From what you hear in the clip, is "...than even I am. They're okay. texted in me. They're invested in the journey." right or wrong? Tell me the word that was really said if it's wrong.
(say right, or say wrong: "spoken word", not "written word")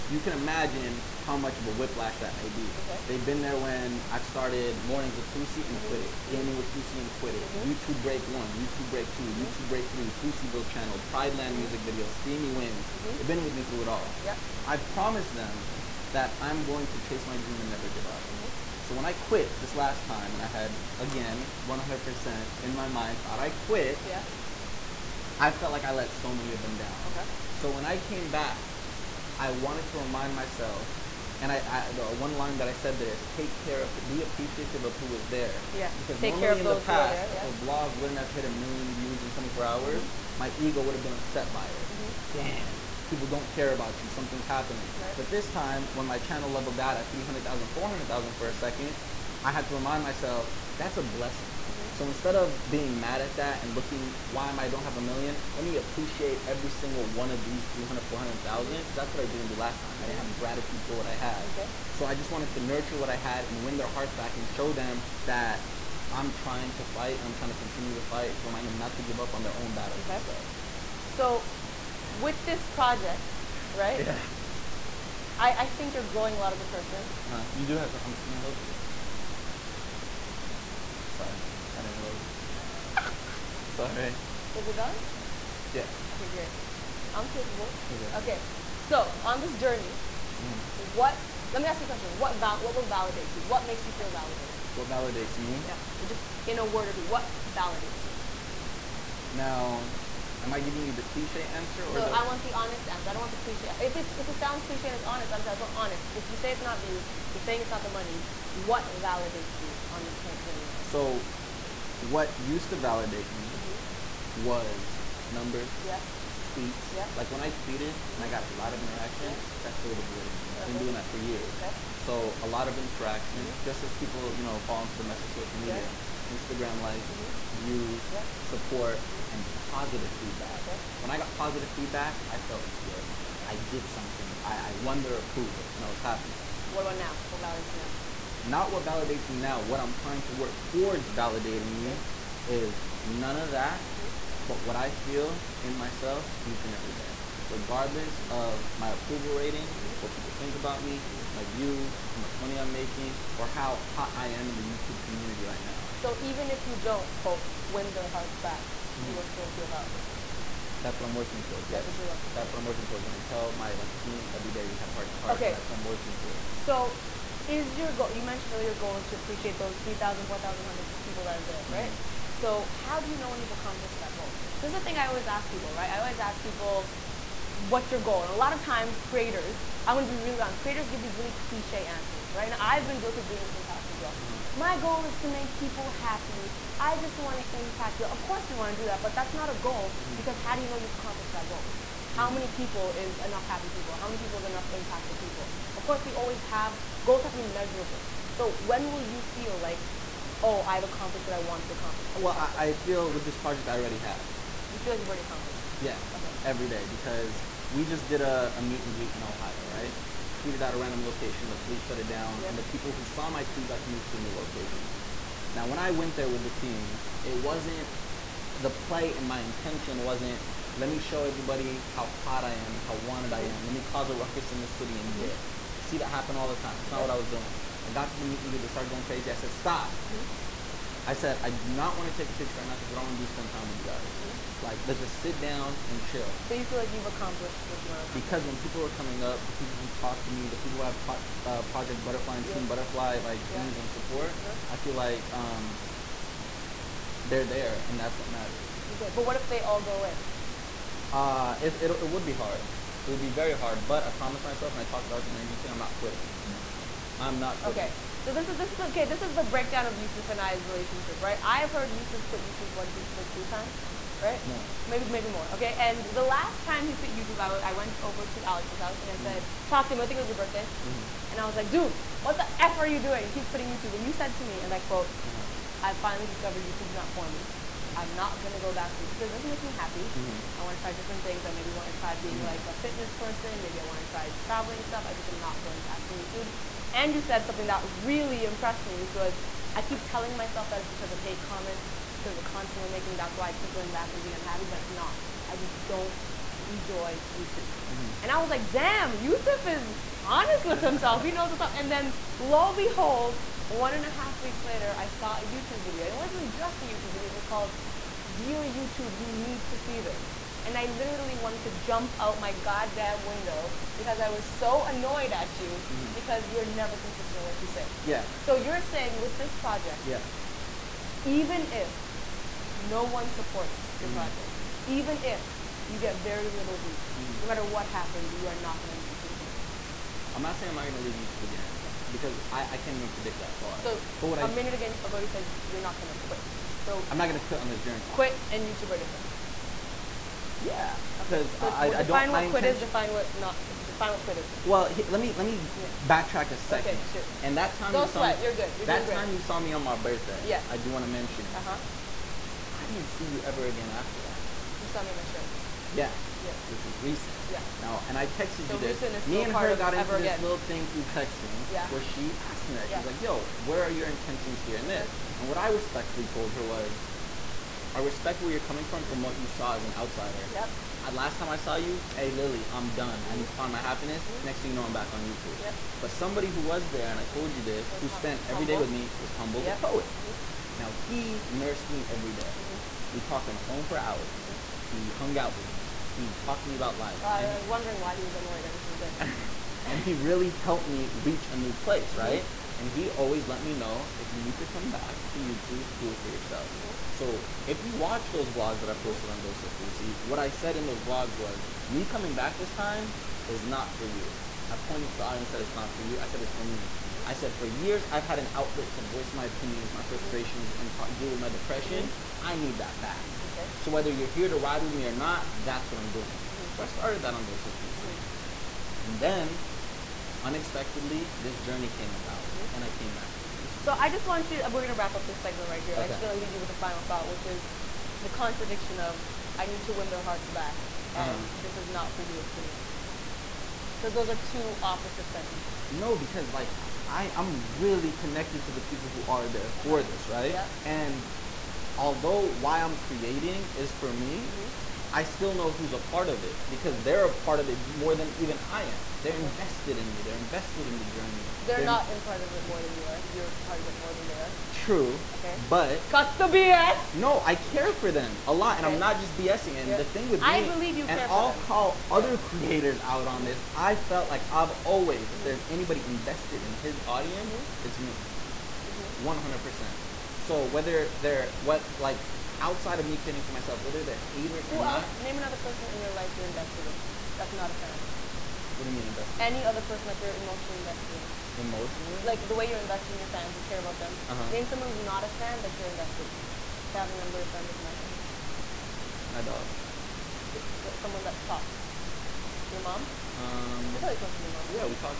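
wrong: "invested", not "texted".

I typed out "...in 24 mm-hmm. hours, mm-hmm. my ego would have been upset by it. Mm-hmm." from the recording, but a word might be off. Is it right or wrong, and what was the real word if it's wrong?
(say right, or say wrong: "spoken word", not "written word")
right.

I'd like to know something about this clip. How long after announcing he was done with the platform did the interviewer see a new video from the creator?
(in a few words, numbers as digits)
1.5 weeks.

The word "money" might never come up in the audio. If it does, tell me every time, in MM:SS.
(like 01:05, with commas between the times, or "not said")
01:48, 02:32.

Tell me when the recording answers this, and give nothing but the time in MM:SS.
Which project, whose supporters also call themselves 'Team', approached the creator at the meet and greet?
04:01.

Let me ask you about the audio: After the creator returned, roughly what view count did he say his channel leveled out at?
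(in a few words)
300,000.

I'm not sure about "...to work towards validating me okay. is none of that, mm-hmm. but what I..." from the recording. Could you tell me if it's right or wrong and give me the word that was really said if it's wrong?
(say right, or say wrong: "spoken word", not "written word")
right.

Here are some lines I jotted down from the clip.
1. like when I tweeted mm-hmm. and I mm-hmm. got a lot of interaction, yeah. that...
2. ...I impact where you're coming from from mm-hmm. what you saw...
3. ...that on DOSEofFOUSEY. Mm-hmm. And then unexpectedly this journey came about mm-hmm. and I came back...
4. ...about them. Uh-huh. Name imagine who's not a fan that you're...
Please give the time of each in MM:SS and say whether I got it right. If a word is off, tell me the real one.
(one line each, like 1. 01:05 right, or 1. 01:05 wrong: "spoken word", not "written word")
1. 01:57 right
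2. 06:07 wrong: "respect", not "impact"
3. 06:57 right
4. 08:03 wrong: "someone", not "imagine".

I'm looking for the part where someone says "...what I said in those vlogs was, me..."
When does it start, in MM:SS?
06:40.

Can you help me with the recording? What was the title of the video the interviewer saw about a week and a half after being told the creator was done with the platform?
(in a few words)
Dear YouTube, you need to see this.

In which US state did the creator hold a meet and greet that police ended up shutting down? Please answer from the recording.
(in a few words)
Ohio.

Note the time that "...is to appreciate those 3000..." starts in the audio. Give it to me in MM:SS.
02:48.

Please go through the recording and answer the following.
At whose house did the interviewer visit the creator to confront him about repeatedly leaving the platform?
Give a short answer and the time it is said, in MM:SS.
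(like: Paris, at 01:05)
Alex, at 04:28.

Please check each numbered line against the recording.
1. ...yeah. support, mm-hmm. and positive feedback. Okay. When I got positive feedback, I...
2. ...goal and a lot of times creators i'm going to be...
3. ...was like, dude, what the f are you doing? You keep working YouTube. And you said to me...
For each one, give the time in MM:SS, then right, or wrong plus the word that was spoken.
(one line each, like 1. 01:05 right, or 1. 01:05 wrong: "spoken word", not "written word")
1. 02:08 right
2. 02:58 right
3. 04:31 wrong: "quitting", not "working".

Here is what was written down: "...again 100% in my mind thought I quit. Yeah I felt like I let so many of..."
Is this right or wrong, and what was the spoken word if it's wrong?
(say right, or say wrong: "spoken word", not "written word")
right.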